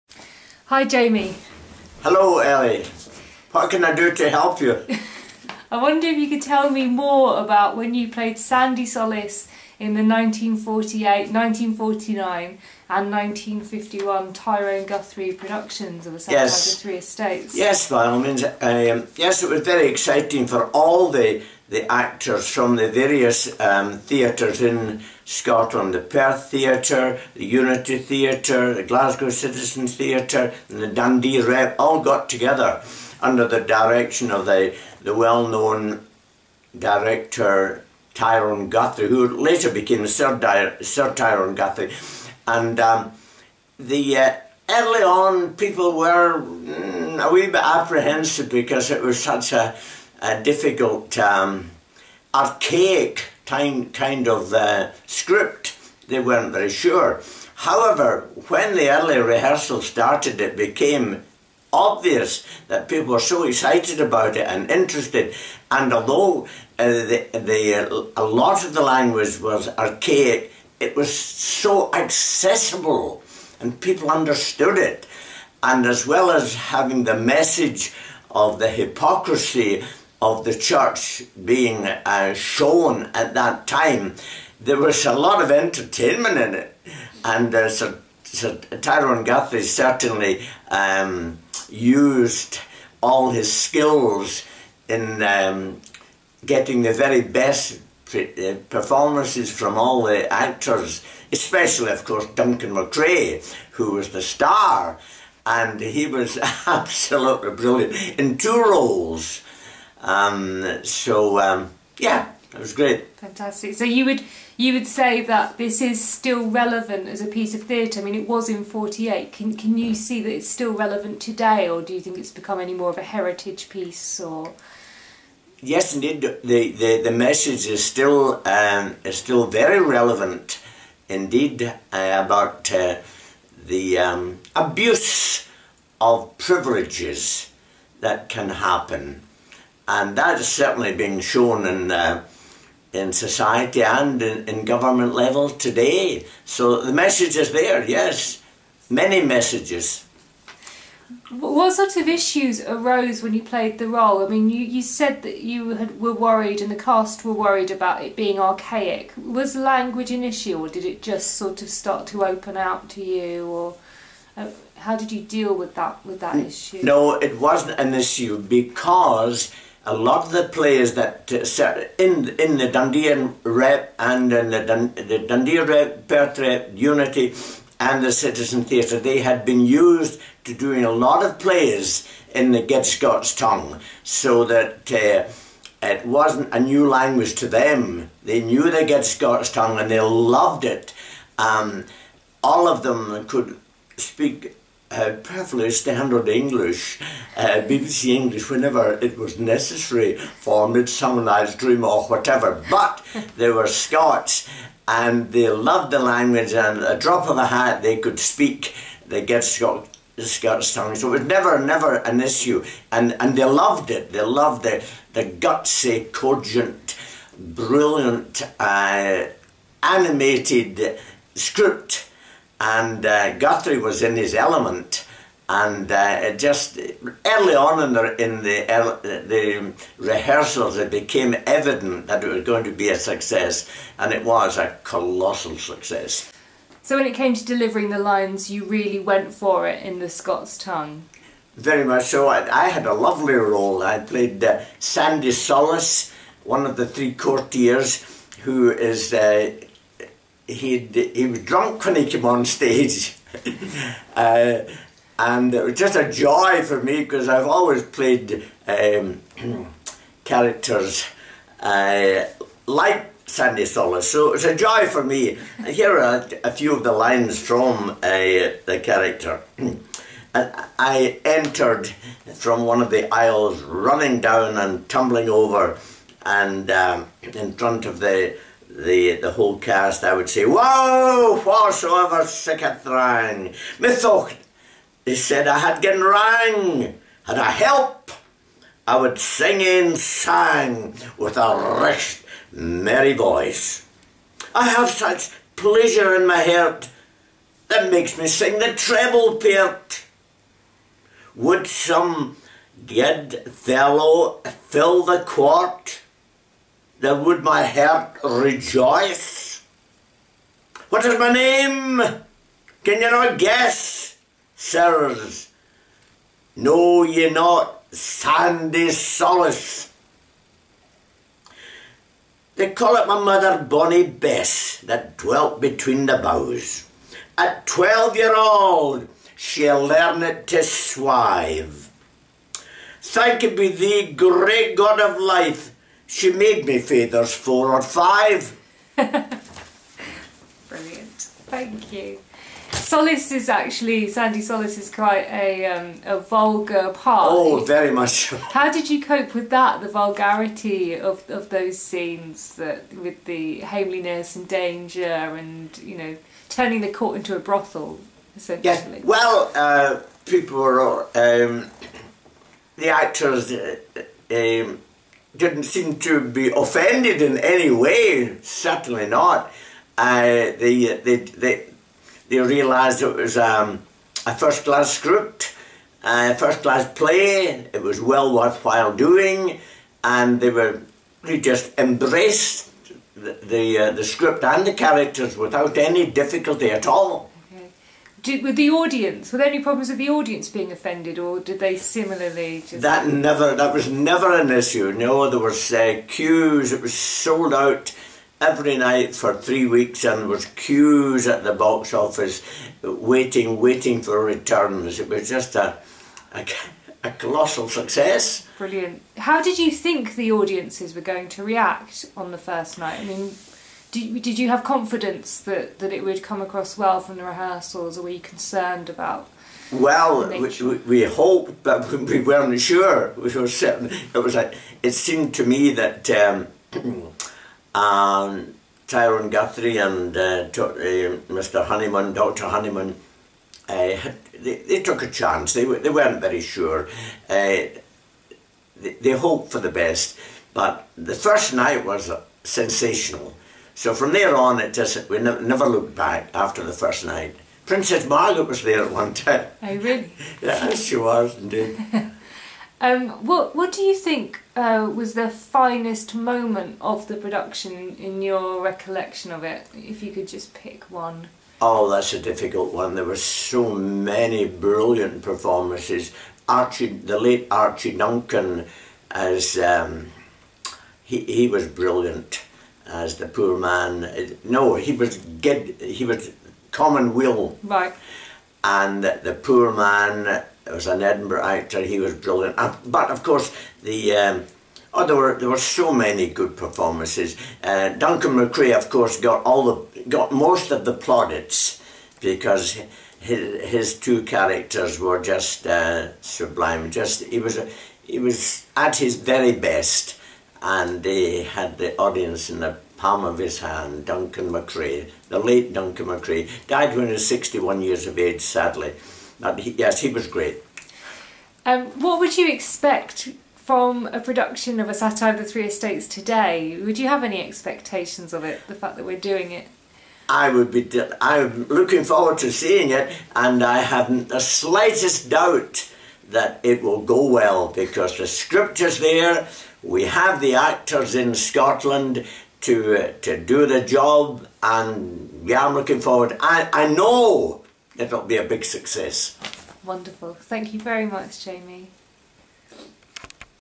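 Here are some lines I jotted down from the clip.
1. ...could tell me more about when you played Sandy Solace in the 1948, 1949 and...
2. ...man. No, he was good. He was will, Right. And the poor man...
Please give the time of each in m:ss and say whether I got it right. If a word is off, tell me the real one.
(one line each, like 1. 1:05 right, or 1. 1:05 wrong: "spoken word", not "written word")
1. 0:06 right
2. 7:53 right.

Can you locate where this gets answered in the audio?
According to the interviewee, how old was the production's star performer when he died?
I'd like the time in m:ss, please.
8:27.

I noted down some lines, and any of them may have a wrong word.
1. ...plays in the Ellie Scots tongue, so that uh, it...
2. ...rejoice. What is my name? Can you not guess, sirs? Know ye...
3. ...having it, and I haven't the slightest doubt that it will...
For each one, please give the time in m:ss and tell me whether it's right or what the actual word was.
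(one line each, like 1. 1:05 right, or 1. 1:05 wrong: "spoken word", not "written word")
1. 3:01 wrong: "Get", not "Ellie"
2. 5:08 right
3. 8:42 wrong: "seeing", not "having".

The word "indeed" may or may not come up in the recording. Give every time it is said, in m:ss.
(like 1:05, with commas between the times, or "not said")
2:05, 2:11, 7:31.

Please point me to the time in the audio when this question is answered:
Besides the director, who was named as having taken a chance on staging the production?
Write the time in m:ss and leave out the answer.
7:12.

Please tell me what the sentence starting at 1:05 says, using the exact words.
And although uh, the, the, a lot of the language was archaic, it was so accessible and people understood it.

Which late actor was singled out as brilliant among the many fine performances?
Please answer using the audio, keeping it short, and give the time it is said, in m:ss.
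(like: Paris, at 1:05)
Archie Duncan, at 7:47.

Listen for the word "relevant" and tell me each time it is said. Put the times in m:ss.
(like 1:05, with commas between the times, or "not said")
1:56, 2:00, 2:09.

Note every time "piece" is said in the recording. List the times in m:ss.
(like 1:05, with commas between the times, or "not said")
1:57, 2:03.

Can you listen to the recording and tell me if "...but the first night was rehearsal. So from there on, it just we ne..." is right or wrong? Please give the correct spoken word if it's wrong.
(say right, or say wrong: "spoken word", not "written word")
wrong: "sensational", not "rehearsal".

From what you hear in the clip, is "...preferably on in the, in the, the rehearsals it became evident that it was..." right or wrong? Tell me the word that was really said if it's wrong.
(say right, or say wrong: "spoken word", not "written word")
wrong: "early", not "preferably".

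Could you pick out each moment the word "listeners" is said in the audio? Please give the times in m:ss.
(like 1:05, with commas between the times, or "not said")
not said.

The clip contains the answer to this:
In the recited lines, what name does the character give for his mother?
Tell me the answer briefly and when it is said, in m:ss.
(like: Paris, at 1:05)
Bonnie Bess, at 5:23.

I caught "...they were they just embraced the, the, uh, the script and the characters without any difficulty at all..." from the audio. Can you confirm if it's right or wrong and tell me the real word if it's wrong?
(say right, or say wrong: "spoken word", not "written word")
right.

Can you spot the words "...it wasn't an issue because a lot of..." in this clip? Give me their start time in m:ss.
2:47.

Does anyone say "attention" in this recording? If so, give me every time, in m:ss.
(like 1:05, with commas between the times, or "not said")
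not said.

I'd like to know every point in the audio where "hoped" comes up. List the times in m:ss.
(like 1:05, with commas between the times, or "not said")
7:01, 7:19.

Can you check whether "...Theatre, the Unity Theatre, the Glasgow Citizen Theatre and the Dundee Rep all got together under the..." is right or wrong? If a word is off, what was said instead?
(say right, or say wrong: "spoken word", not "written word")
right.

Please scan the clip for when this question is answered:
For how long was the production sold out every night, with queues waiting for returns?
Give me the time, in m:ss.
6:39.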